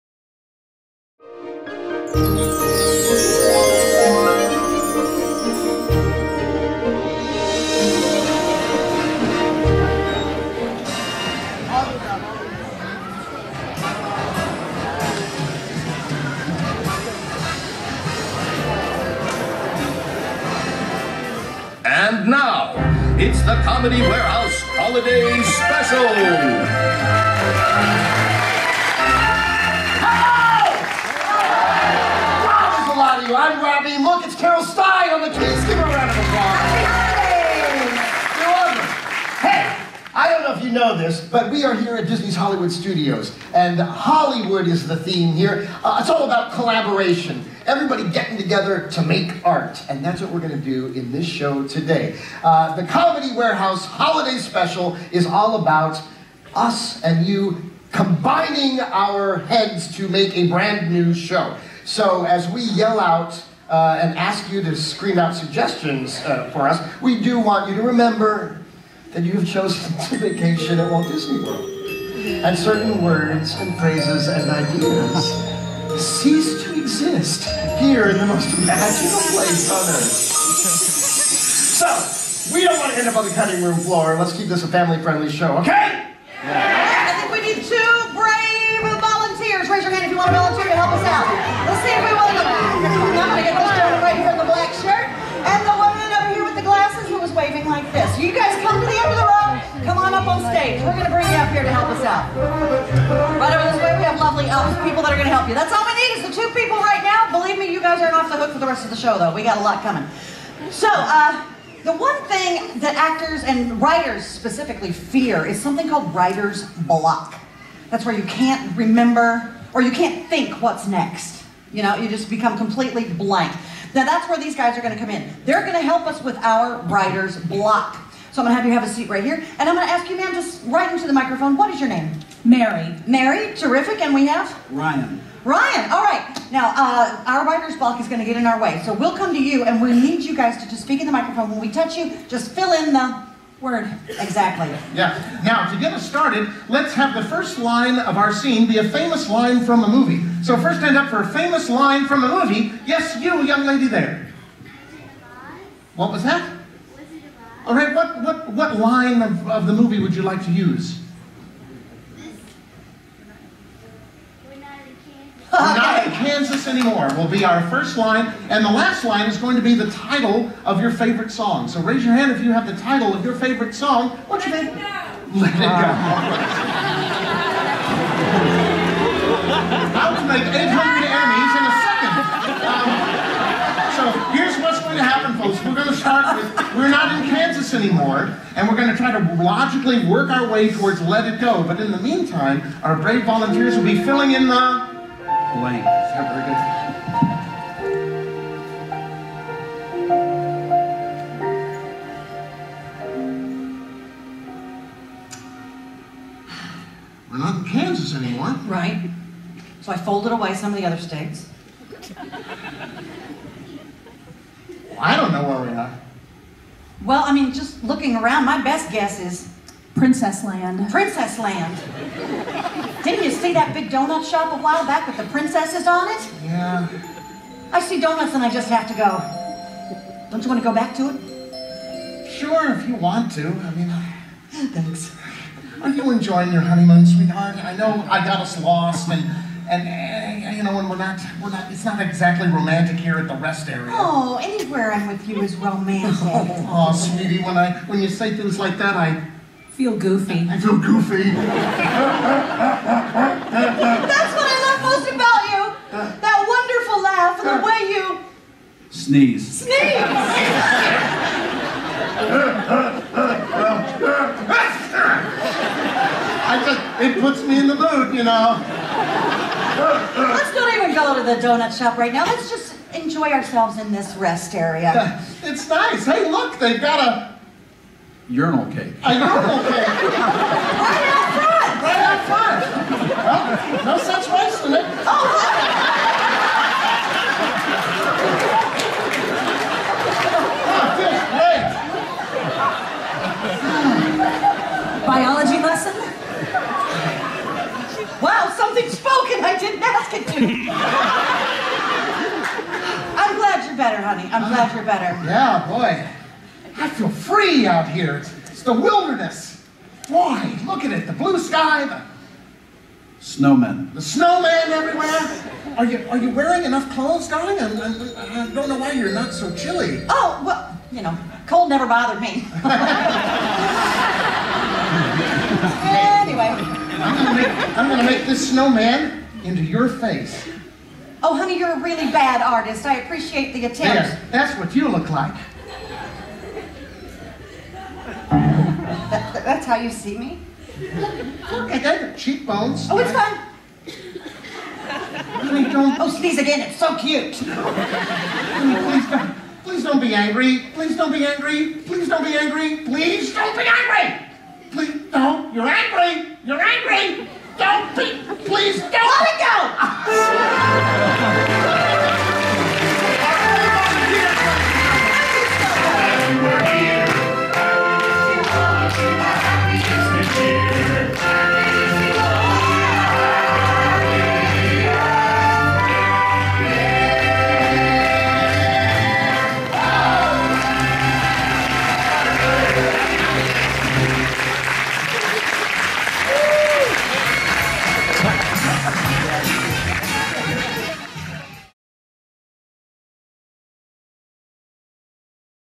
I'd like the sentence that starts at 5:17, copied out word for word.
I, I, I, don't know why you're not so chilly.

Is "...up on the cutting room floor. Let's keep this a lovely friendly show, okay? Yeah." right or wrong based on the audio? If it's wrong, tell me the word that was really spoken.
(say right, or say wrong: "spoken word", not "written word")
wrong: "family", not "lovely".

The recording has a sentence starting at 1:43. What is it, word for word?
Right over this way, we have lovely elves, people that are going to help you.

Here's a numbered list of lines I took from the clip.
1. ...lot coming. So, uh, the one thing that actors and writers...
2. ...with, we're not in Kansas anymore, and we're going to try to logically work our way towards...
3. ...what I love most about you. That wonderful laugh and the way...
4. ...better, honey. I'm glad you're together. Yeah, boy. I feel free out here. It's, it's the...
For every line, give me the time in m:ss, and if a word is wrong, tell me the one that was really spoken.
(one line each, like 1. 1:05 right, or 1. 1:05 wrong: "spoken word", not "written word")
1. 1:49 right
2. 3:06 right
3. 4:14 right
4. 5:03 wrong: "better", not "together".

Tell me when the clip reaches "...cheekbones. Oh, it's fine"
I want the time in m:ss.
5:42.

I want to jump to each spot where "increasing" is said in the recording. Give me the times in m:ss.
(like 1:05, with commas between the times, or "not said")
not said.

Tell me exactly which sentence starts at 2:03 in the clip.
Now that's where these guys are going to come in.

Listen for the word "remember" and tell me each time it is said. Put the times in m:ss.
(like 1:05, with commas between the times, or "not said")
1:07, 1:58.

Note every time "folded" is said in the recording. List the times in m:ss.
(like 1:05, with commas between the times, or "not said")
3:29.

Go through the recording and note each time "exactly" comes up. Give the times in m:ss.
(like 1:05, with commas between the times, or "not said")
2:24, 4:02.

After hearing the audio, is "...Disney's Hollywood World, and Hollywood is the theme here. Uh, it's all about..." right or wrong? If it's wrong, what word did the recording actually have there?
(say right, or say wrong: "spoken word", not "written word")
wrong: "Studios", not "World".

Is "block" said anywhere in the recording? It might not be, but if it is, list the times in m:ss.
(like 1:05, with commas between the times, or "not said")
1:56, 2:07, 2:17.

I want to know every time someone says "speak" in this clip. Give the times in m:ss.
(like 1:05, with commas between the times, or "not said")
2:20.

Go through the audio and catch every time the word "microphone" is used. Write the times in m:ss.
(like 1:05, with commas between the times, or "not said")
2:11, 2:21.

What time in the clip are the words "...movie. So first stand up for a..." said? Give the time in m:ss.
2:29.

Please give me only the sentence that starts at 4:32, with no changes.
Let's just enjoy ourselves in this rest area.